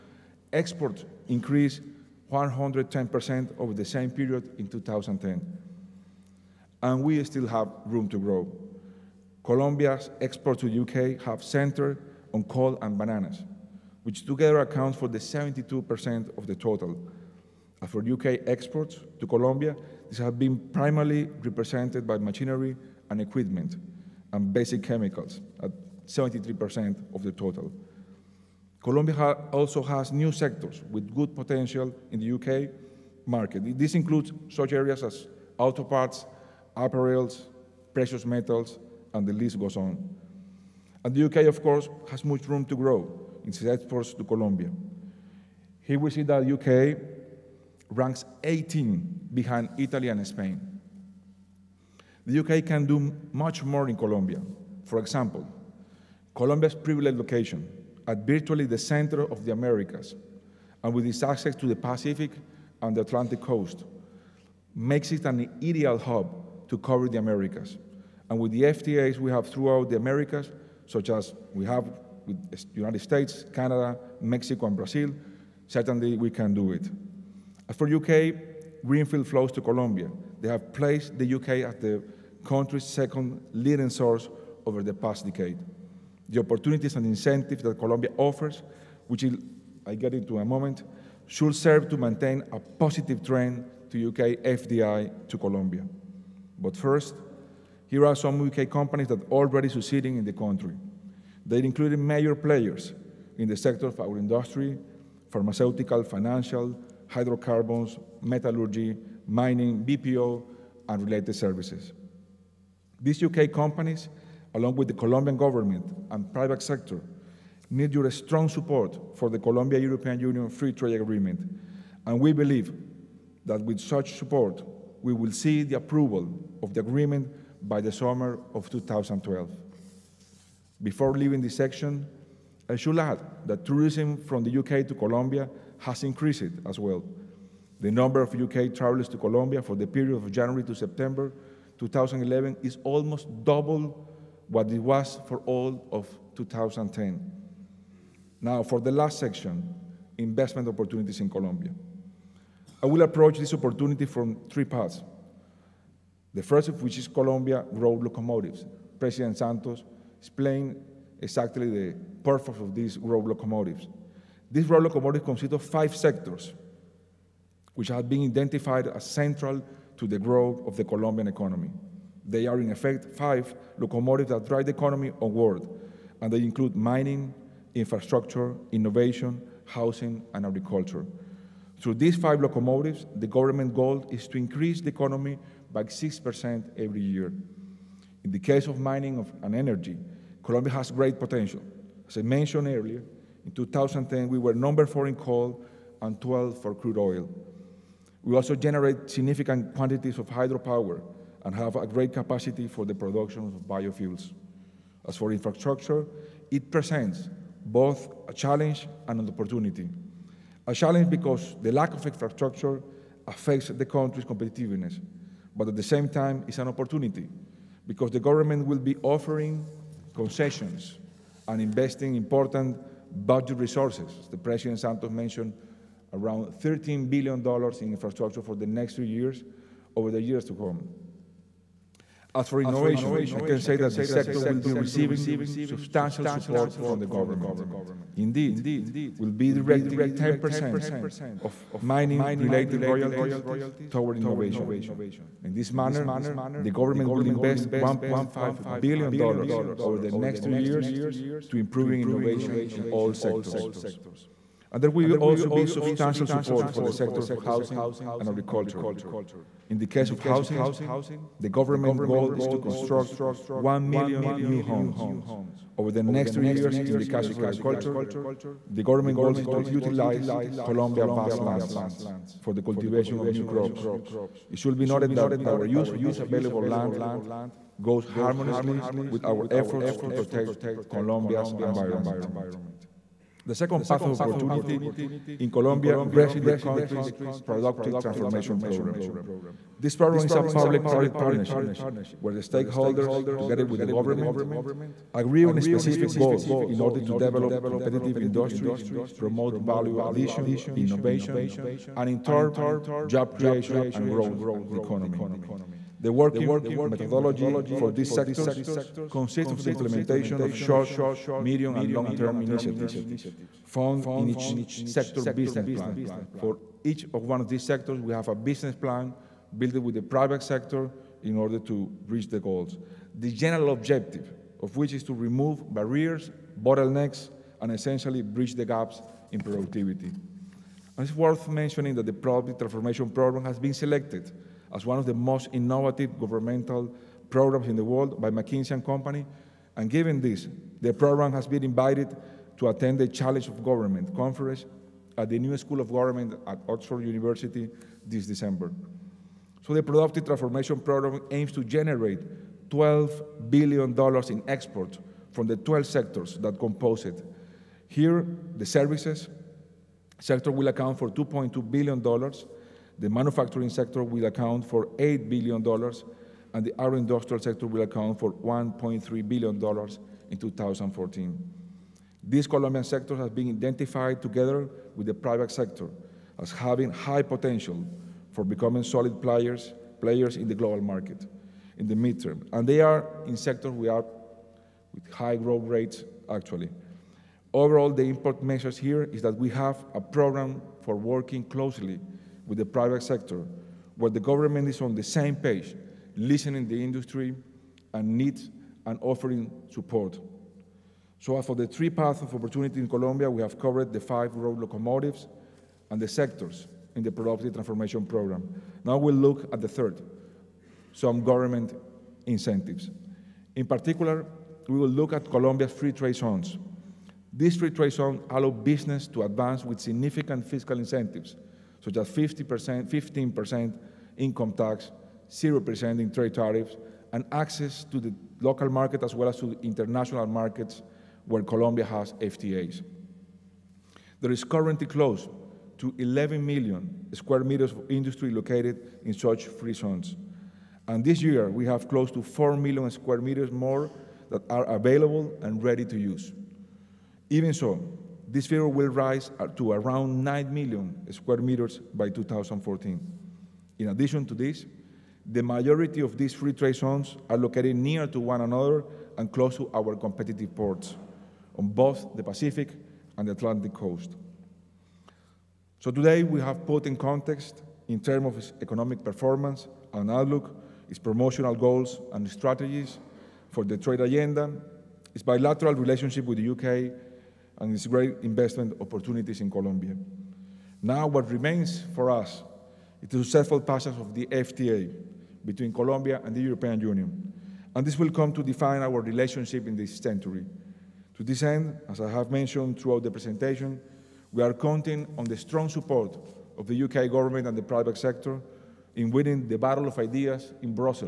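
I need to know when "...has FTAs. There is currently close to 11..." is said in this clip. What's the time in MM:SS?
07:11.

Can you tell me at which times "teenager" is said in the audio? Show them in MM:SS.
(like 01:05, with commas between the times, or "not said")
not said.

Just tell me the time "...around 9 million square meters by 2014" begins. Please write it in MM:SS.
07:29.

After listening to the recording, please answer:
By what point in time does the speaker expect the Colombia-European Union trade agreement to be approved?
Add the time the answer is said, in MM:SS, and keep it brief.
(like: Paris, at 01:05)
summer of 2012, at 02:07.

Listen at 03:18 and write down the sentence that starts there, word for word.
We also generate significant quantities of hydropower and have a great capacity for the production of biofuels.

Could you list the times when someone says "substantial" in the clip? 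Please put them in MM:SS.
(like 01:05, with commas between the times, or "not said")
03:55, 04:15.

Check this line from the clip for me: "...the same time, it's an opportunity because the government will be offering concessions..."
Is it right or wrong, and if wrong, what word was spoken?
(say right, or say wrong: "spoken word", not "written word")
right.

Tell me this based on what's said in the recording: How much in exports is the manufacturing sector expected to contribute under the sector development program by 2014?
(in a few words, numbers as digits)
$8 billion.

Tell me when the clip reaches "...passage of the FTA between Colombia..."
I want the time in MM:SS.
08:03.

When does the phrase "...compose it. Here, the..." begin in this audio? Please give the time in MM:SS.
05:56.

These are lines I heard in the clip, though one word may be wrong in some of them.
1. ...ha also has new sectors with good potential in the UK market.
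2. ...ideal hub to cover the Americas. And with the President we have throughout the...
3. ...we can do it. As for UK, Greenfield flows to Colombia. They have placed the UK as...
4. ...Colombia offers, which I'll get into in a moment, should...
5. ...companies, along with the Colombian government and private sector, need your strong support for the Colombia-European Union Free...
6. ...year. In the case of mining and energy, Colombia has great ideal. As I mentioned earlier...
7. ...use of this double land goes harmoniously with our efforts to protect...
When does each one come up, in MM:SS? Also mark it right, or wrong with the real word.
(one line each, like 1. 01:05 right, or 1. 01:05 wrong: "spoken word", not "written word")
1. 00:29 right
2. 01:05 wrong: "FTAs", not "President"
3. 01:16 right
4. 01:27 right
5. 01:53 right
6. 03:07 wrong: "potential", not "ideal"
7. 04:35 wrong: "available", not "double".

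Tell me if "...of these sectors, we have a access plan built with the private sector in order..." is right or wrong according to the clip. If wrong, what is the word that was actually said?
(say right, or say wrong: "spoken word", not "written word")
wrong: "business", not "access".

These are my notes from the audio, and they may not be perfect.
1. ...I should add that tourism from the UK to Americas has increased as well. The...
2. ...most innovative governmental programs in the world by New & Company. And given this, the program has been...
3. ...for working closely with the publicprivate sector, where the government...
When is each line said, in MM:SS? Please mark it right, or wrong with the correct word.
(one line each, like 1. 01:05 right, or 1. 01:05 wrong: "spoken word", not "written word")
1. 02:12 wrong: "Colombia", not "Americas"
2. 05:35 wrong: "McKinsey", not "New"
3. 06:30 wrong: "private", not "publicprivate".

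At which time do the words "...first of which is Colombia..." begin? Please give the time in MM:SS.
02:36.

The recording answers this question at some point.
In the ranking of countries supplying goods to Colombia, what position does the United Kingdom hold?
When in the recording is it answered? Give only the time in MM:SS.
00:48.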